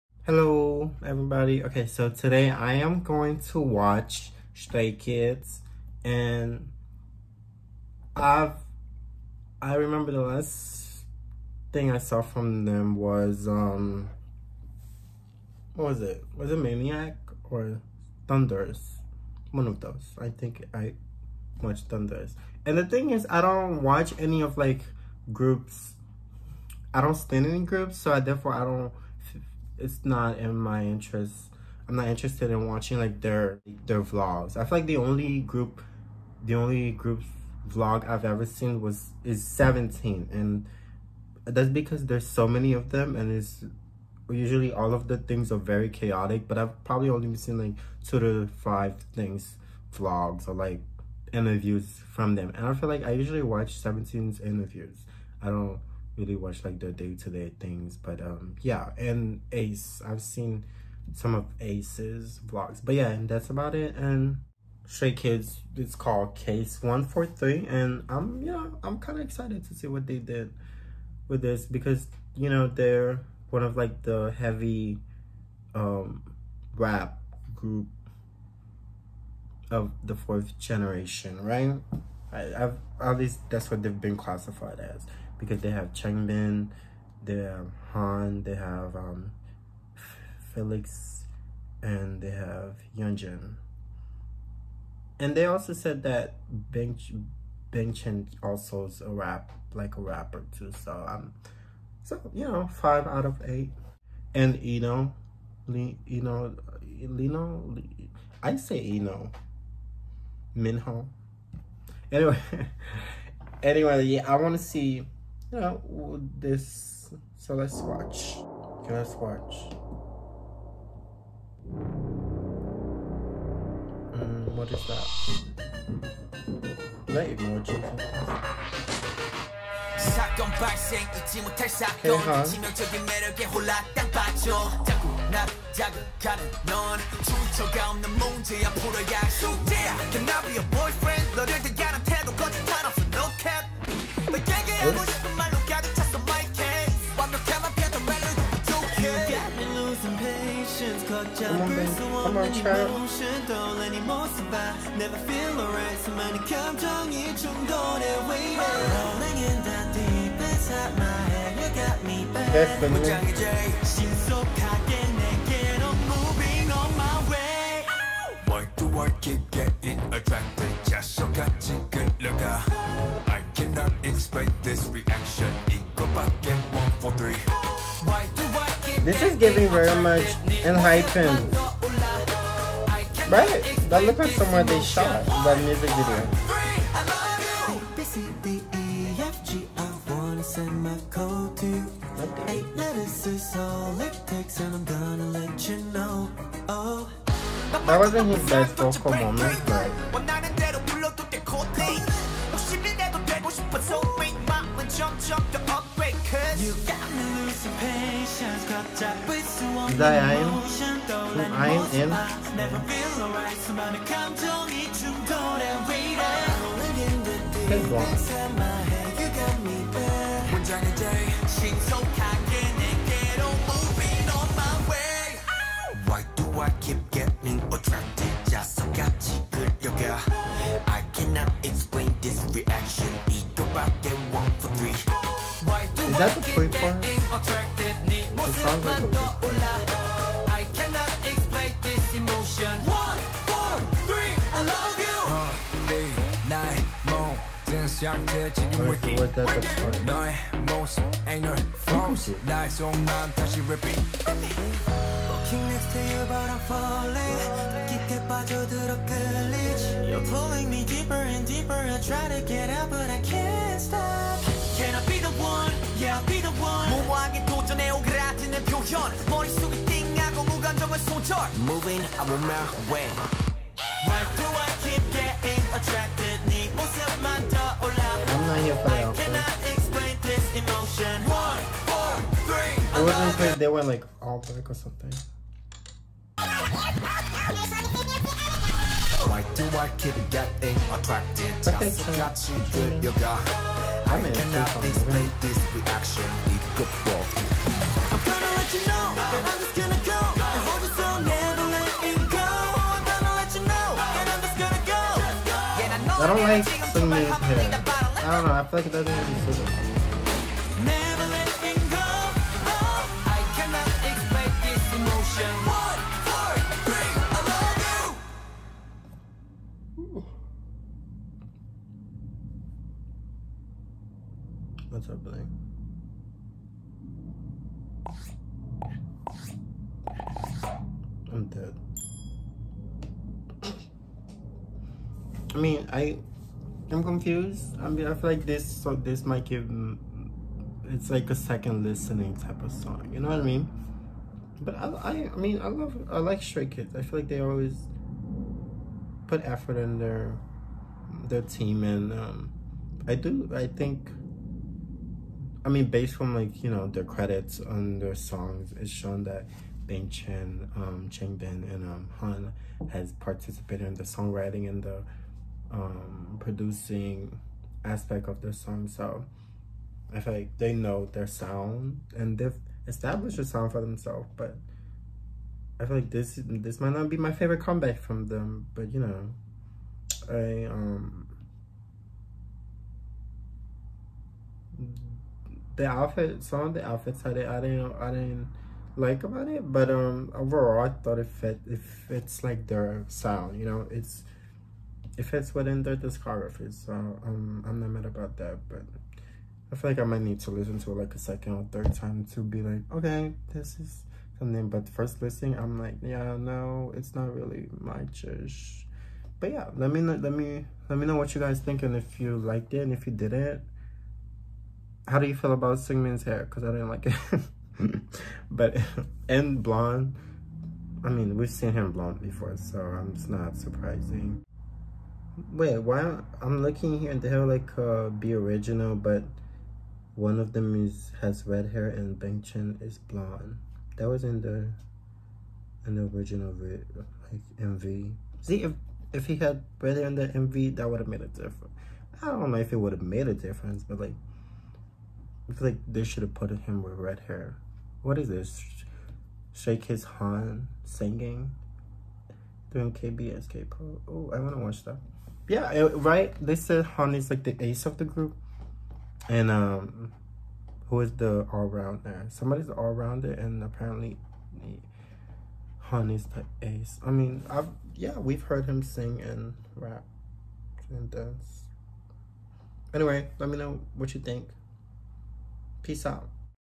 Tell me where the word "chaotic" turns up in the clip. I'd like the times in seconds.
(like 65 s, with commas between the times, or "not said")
45 s.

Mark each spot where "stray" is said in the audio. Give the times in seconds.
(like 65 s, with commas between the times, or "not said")
4 s, 64 s, 346 s.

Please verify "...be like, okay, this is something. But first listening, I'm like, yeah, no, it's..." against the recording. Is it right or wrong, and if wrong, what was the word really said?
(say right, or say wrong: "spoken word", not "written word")
right.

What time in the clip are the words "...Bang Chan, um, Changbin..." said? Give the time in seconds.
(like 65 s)
359 s.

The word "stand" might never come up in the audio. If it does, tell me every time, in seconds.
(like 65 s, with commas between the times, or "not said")
27 s.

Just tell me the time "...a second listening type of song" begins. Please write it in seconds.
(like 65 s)
341 s.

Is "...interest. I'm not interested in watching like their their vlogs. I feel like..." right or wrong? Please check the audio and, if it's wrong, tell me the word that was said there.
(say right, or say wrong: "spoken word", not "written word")
right.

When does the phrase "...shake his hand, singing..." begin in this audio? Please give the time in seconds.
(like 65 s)
449 s.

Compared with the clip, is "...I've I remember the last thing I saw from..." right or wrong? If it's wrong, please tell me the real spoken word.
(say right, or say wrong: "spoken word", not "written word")
right.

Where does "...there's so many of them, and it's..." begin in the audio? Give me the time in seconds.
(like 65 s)
42 s.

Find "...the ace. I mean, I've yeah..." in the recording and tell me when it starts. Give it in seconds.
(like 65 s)
466 s.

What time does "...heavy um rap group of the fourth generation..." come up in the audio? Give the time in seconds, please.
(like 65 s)
74 s.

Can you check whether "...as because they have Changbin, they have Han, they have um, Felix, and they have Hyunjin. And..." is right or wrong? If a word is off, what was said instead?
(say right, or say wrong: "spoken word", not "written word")
right.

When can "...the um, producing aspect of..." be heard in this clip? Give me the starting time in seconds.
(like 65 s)
364 s.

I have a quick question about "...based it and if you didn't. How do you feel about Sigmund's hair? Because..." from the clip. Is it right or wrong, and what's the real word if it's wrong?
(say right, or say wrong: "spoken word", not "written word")
wrong: "liked", not "based".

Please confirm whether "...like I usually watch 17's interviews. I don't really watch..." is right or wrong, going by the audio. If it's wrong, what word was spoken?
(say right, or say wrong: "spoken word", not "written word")
right.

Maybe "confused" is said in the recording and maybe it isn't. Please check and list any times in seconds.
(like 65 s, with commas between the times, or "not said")
337 s.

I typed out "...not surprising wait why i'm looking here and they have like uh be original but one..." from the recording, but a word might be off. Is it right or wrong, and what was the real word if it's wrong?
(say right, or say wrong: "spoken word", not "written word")
right.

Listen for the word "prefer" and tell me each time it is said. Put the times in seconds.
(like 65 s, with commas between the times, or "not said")
not said.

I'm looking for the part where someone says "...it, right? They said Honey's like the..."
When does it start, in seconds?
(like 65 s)
455 s.